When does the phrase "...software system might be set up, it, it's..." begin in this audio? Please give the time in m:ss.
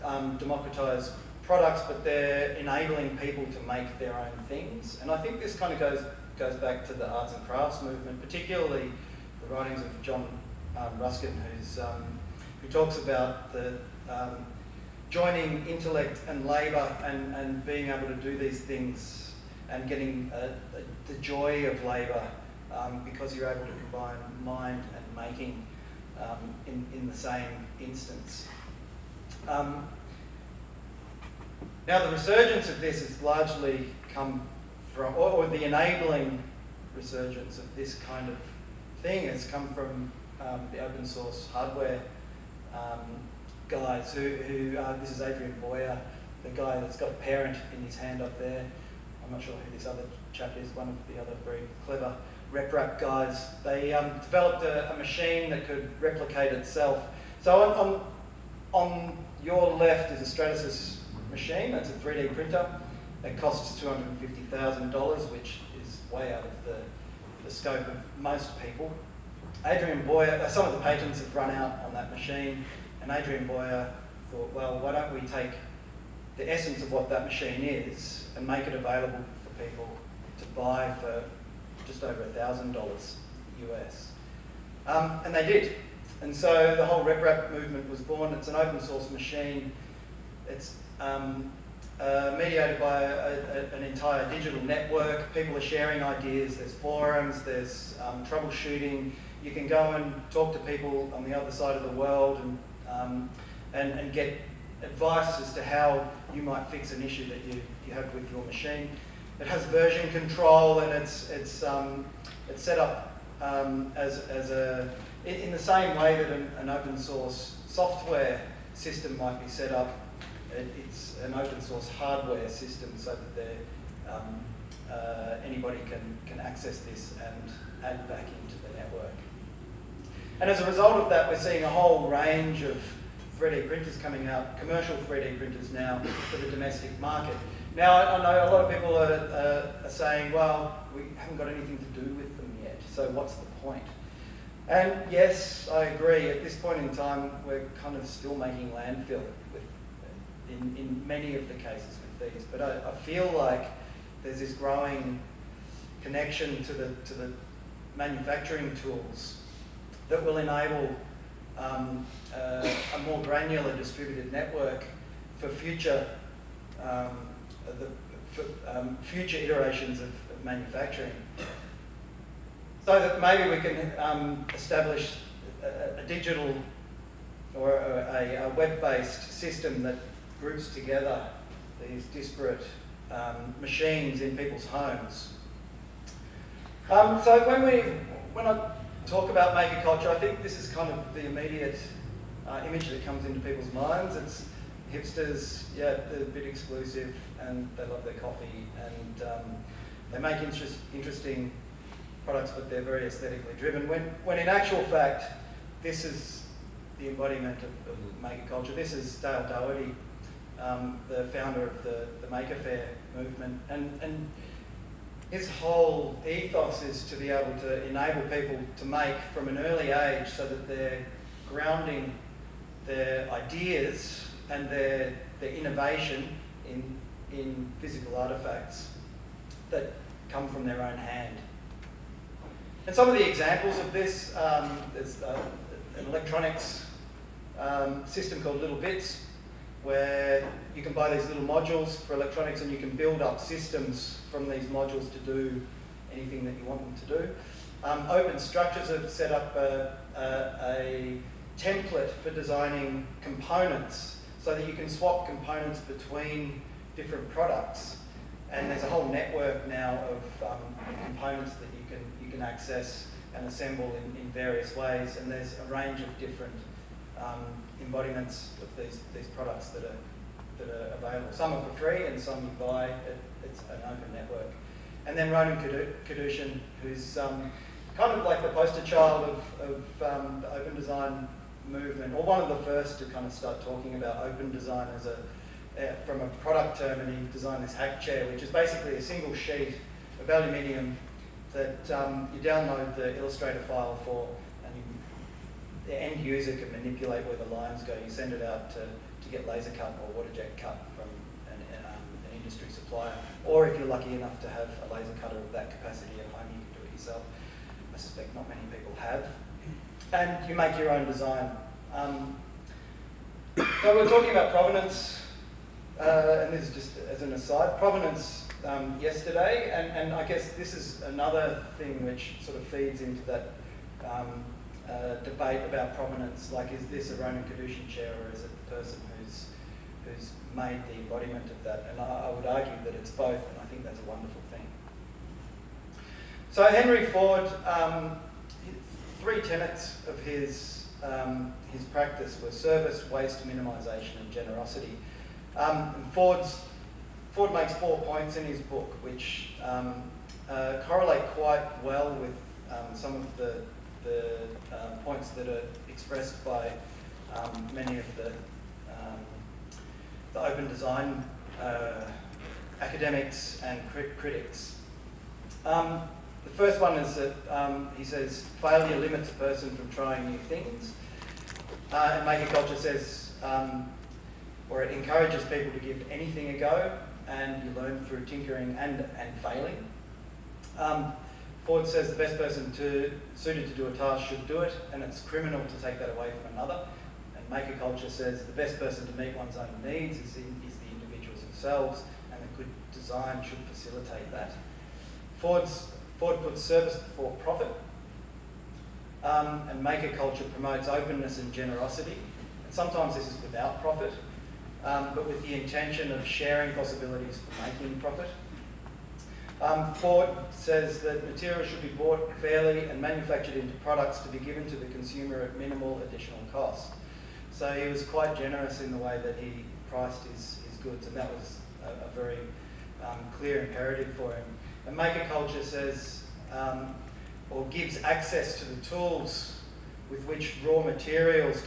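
1:57.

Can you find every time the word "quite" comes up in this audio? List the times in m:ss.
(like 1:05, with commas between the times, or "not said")
5:51, 6:58.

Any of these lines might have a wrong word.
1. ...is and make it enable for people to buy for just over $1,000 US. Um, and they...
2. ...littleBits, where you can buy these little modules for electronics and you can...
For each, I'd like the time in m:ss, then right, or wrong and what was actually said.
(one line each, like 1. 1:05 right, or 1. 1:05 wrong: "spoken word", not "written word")
1. 1:17 wrong: "available", not "enable"
2. 3:58 right.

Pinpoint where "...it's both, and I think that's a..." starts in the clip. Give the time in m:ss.
5:32.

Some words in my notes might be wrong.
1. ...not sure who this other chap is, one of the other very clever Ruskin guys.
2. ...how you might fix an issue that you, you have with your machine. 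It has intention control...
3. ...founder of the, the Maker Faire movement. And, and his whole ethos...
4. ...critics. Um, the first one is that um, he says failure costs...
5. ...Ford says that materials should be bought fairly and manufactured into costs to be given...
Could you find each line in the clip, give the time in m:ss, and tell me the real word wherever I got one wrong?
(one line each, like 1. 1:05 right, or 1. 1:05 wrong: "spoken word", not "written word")
1. 0:49 wrong: "RepRap", not "Ruskin"
2. 1:45 wrong: "version", not "intention"
3. 3:31 right
4. 6:04 wrong: "limits", not "costs"
5. 6:49 wrong: "products", not "costs".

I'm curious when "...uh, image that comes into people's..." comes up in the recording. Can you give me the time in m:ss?
3:12.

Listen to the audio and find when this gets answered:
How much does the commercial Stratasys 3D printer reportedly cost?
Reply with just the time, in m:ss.
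1:03.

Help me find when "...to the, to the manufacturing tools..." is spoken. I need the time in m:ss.
2:36.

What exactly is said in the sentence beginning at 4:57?
You send it out to, to get laser cut or water jet cut from an, um, an industry supplier.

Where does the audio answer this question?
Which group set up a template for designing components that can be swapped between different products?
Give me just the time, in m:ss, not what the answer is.
4:08.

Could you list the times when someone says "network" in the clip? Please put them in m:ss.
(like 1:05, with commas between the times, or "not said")
1:34, 2:08, 2:44, 4:19, 4:34.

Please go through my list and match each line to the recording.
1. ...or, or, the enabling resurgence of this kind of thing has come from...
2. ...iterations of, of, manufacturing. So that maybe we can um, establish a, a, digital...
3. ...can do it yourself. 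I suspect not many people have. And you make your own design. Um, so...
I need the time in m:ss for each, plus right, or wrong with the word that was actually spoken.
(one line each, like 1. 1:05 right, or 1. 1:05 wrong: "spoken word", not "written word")
1. 0:35 right
2. 2:49 right
3. 5:06 right.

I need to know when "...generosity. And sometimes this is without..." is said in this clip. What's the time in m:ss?
6:41.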